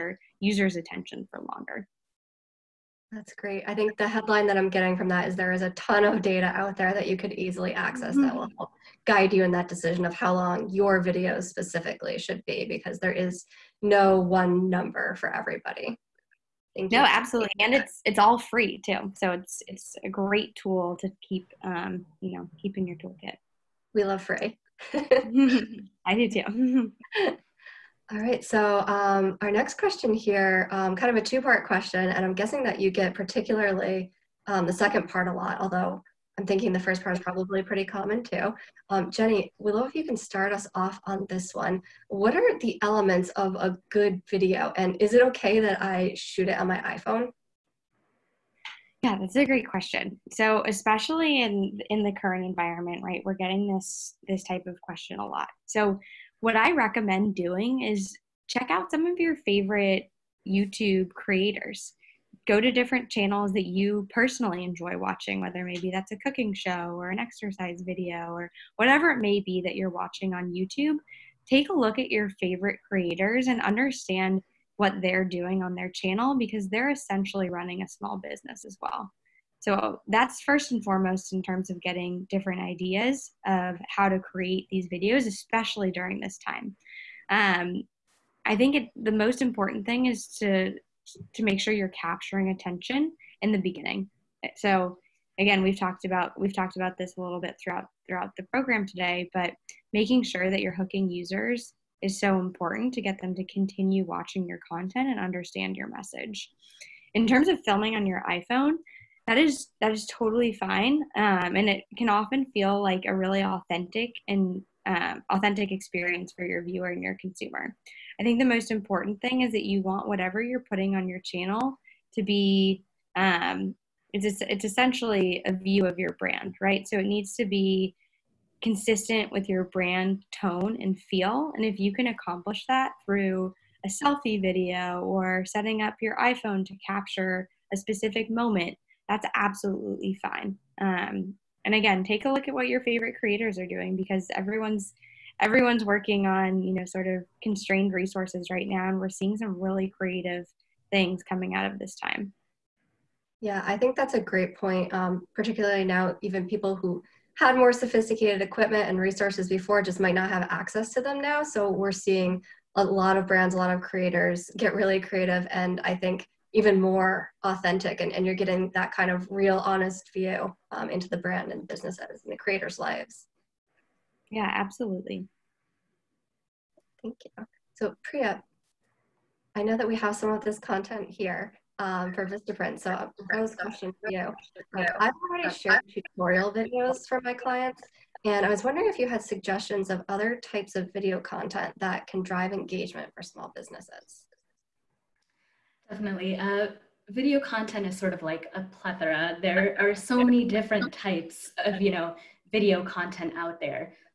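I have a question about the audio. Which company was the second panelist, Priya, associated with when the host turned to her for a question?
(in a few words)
Vistaprint.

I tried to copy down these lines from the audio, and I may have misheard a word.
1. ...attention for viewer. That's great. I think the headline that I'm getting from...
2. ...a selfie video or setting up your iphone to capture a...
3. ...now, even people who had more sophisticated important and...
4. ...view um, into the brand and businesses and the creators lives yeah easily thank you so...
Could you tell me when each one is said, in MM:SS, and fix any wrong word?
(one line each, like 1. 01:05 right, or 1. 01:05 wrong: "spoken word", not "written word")
1. 00:00 wrong: "longer", not "viewer"
2. 02:13 right
3. 02:35 wrong: "equipment", not "important"
4. 02:50 wrong: "absolutely", not "easily".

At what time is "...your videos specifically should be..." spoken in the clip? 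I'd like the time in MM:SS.
00:10.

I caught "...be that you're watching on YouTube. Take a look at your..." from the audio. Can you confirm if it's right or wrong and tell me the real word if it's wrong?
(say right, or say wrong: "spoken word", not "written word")
right.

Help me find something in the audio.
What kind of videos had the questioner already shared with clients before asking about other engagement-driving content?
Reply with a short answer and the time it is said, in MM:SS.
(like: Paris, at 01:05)
Tutorial videos, at 03:05.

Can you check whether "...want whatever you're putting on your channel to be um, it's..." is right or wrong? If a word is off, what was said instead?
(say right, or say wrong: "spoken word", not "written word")
right.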